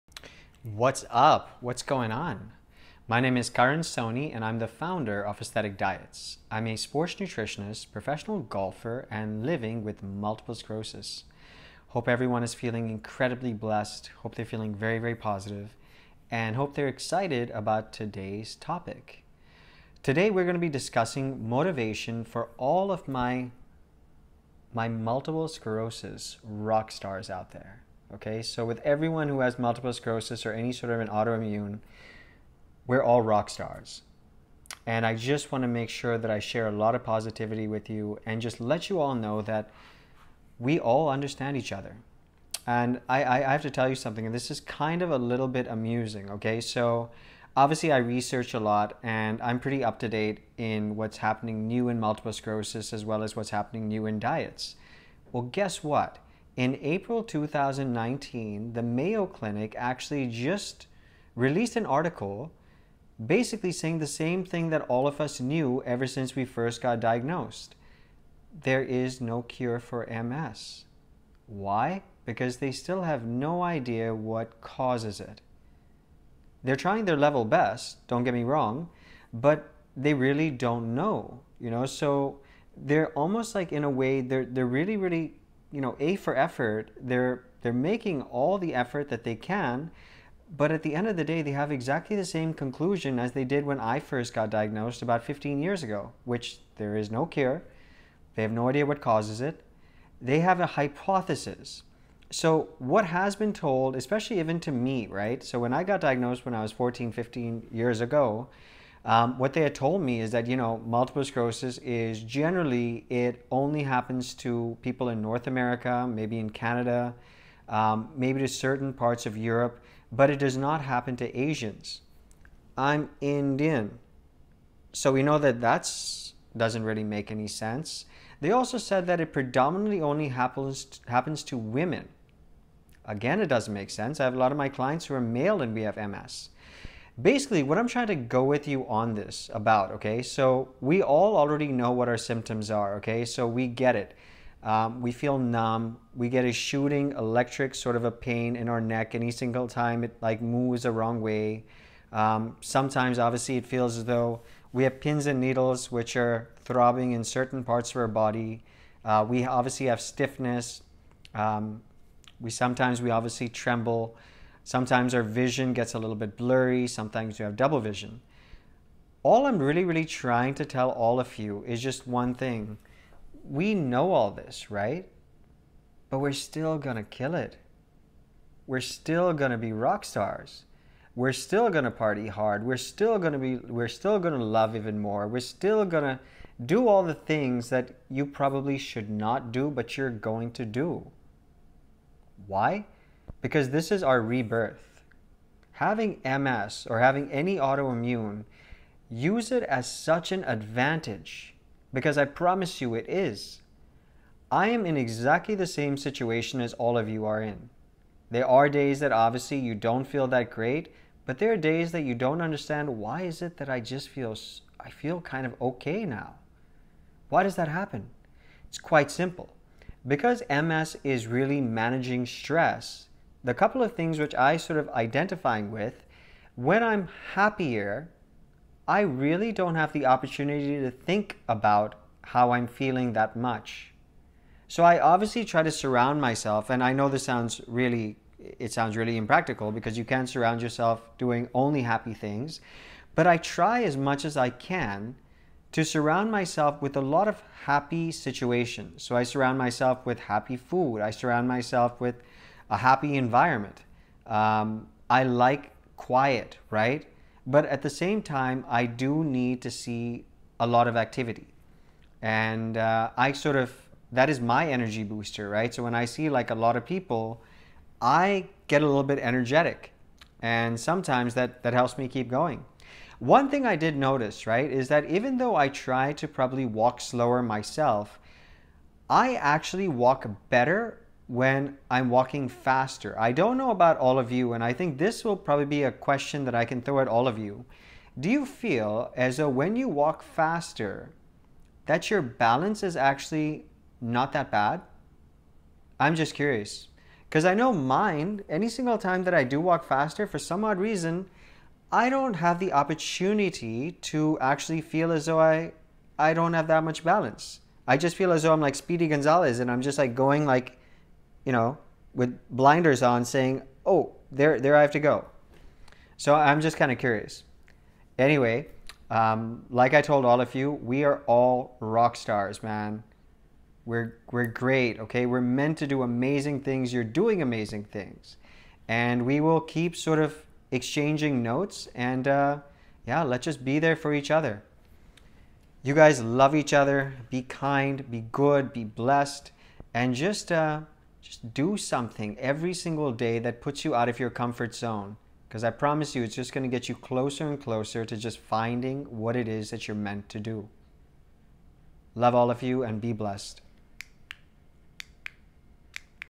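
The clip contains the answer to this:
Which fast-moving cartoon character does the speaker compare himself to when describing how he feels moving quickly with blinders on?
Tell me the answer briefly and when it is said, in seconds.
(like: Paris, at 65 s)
Speedy Gonzalez, at 308 s.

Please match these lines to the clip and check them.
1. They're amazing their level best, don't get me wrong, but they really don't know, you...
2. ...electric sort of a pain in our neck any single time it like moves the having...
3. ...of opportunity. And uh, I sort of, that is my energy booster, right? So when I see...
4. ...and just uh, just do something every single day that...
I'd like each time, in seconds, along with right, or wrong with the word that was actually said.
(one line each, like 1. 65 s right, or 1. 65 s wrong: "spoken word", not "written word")
1. 76 s wrong: "trying", not "amazing"
2. 147 s wrong: "wrong", not "having"
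3. 260 s wrong: "activity", not "opportunity"
4. 339 s right.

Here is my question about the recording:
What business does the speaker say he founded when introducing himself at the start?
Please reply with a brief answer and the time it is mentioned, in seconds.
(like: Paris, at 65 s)
Aesthetic Diets, at 5 s.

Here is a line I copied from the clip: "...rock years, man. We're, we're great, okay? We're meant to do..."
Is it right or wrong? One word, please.
wrong.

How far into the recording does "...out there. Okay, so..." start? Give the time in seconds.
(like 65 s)
27 s.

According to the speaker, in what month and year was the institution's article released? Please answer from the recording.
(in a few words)
April 2019.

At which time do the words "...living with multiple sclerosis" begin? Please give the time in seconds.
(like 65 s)
9 s.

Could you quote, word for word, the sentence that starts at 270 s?
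And sometimes that, that helps me keep going.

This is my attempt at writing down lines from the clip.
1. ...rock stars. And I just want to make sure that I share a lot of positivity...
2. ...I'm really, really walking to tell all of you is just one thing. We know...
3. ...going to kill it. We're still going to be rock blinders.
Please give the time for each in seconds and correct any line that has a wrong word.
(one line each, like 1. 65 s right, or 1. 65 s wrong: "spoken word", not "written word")
1. 33 s right
2. 169 s wrong: "trying", not "walking"
3. 176 s wrong: "stars", not "blinders".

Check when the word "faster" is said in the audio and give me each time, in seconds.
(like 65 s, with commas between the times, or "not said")
282 s, 290 s, 299 s.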